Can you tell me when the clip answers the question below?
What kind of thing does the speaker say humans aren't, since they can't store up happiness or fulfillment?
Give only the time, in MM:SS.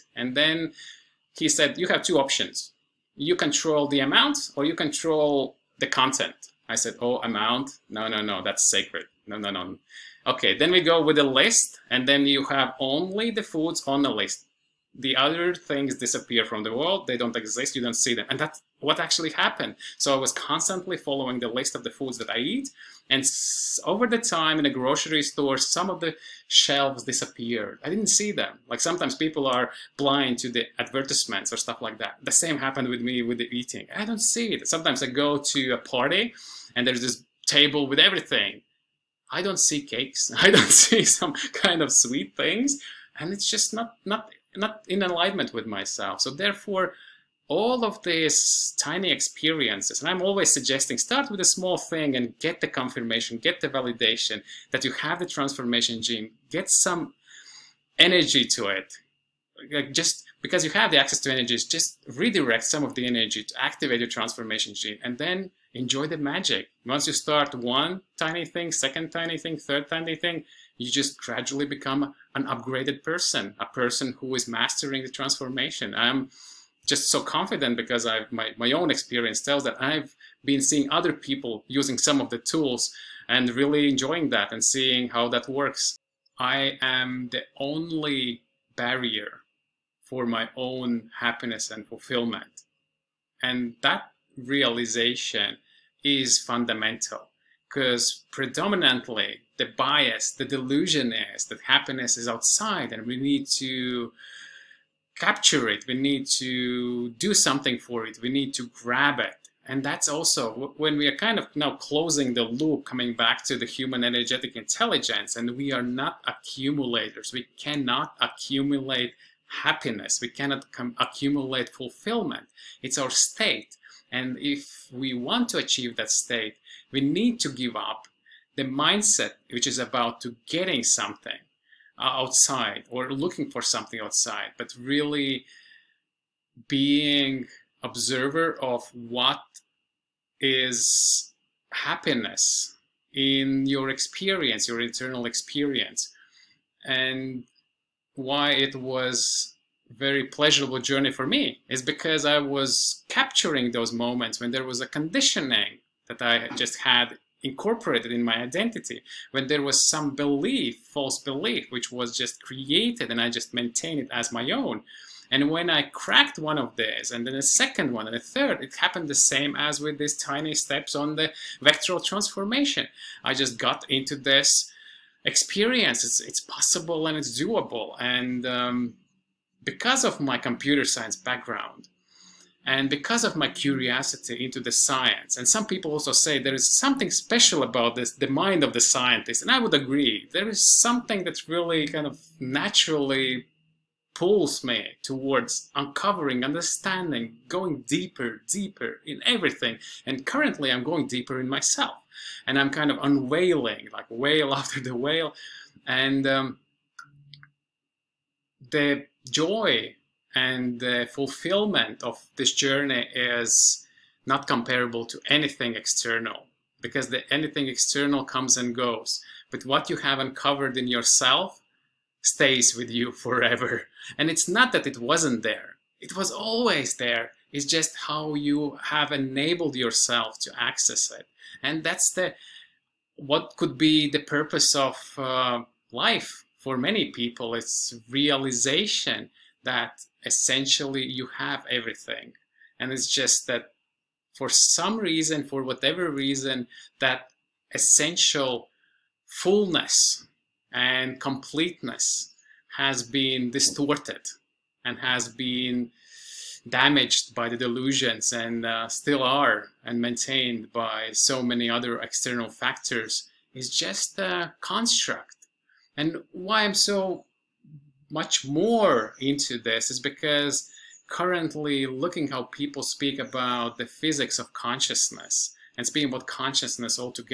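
01:56.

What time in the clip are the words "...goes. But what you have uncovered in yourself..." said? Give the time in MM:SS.
03:38.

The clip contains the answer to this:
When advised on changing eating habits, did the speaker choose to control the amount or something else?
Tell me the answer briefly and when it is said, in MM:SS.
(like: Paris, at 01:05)
the content, at 00:05.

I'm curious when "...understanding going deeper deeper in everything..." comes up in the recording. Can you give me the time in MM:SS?
03:16.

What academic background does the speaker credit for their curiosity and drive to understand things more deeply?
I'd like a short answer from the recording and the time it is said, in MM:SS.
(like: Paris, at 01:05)
computer science, at 03:00.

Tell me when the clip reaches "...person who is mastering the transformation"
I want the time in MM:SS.
01:13.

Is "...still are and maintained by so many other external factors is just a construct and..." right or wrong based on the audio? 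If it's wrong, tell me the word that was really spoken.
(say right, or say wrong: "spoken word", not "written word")
right.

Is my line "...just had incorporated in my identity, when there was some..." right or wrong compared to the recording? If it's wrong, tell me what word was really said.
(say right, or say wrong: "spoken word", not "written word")
right.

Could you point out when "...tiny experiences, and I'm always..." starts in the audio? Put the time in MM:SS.
00:48.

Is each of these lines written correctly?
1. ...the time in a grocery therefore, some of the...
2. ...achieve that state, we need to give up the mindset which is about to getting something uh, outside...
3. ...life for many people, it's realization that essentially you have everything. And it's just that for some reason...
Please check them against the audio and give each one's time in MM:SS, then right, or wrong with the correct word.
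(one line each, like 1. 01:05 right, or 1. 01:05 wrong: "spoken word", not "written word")
1. 00:24 wrong: "store", not "therefore"
2. 02:05 right
3. 03:55 right.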